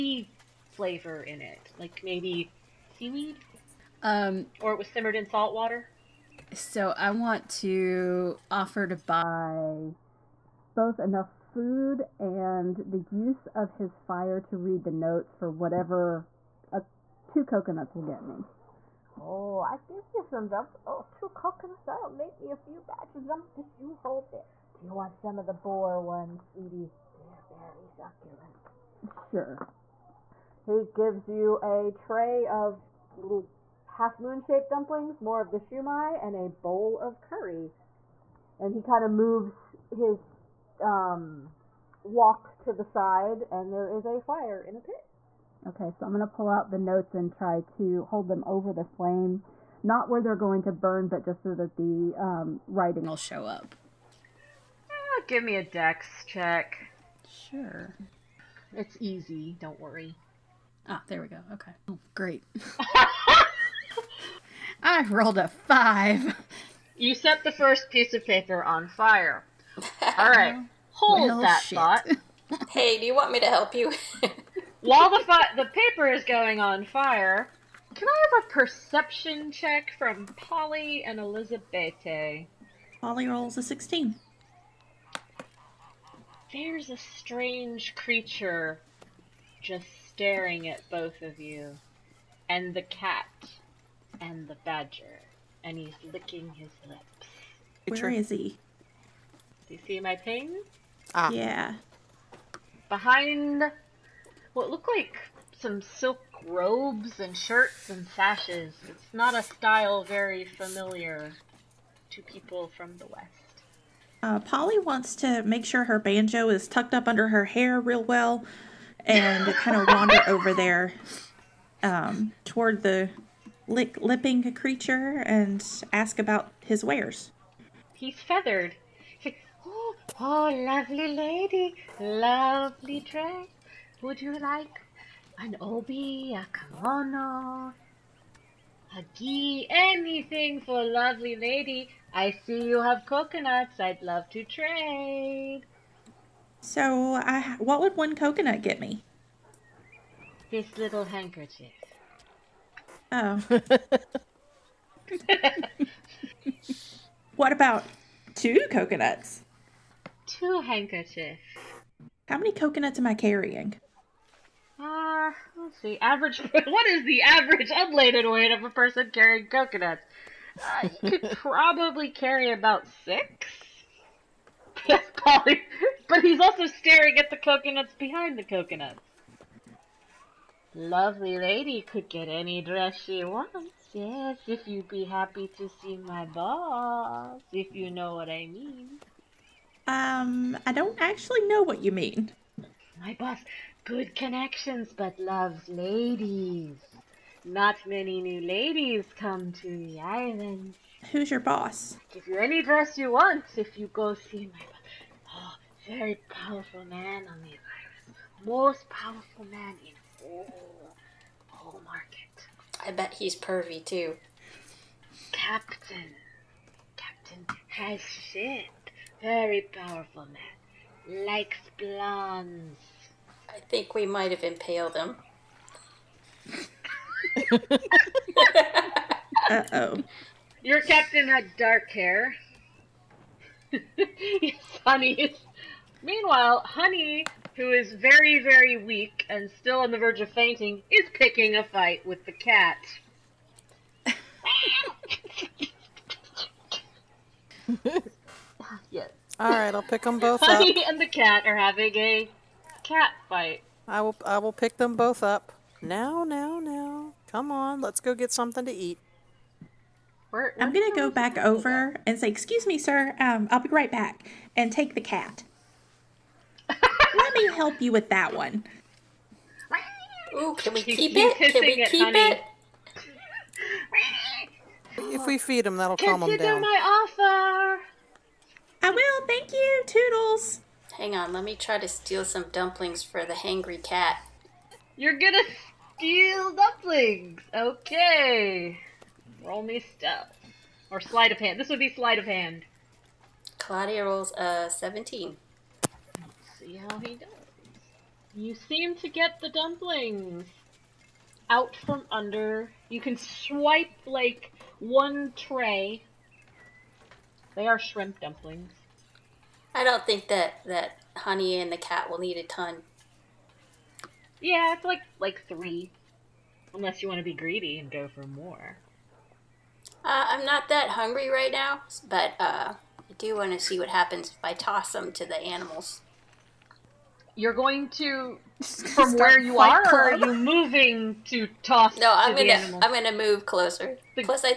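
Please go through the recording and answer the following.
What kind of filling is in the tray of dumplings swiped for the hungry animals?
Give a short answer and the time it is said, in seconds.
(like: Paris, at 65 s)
Shrimp, at 307 s.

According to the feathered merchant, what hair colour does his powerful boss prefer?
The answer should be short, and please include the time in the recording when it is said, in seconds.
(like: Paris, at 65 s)
Blondes, at 221 s.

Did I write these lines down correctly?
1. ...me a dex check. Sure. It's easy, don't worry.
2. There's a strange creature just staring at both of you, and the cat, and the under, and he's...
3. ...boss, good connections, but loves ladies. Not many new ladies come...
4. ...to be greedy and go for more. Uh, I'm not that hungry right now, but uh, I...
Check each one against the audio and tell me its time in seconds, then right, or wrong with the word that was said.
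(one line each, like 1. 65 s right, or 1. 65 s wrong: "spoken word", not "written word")
1. 55 s right
2. 86 s wrong: "badger", not "under"
3. 193 s right
4. 317 s right.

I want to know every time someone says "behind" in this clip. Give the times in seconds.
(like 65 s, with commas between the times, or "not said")
102 s, 177 s.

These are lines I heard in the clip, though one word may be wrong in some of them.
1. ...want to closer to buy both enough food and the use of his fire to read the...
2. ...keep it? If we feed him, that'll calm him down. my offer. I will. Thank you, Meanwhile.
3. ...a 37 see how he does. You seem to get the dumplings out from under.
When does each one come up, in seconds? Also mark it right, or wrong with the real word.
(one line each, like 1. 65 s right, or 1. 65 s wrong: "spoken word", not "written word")
1. 7 s wrong: "offer", not "closer"
2. 271 s wrong: "Toodles", not "Meanwhile"
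3. 294 s wrong: "17", not "37".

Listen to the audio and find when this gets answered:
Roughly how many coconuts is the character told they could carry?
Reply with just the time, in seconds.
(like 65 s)
173 s.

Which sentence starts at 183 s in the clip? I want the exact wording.
Yes, if you'd be happy to see my boss, if you know what I mean.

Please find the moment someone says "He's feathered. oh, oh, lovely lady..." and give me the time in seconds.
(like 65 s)
127 s.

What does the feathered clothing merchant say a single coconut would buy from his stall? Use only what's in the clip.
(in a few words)
This little handkerchief.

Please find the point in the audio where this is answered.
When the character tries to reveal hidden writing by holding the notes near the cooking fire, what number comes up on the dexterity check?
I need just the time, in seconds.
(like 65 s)
65 s.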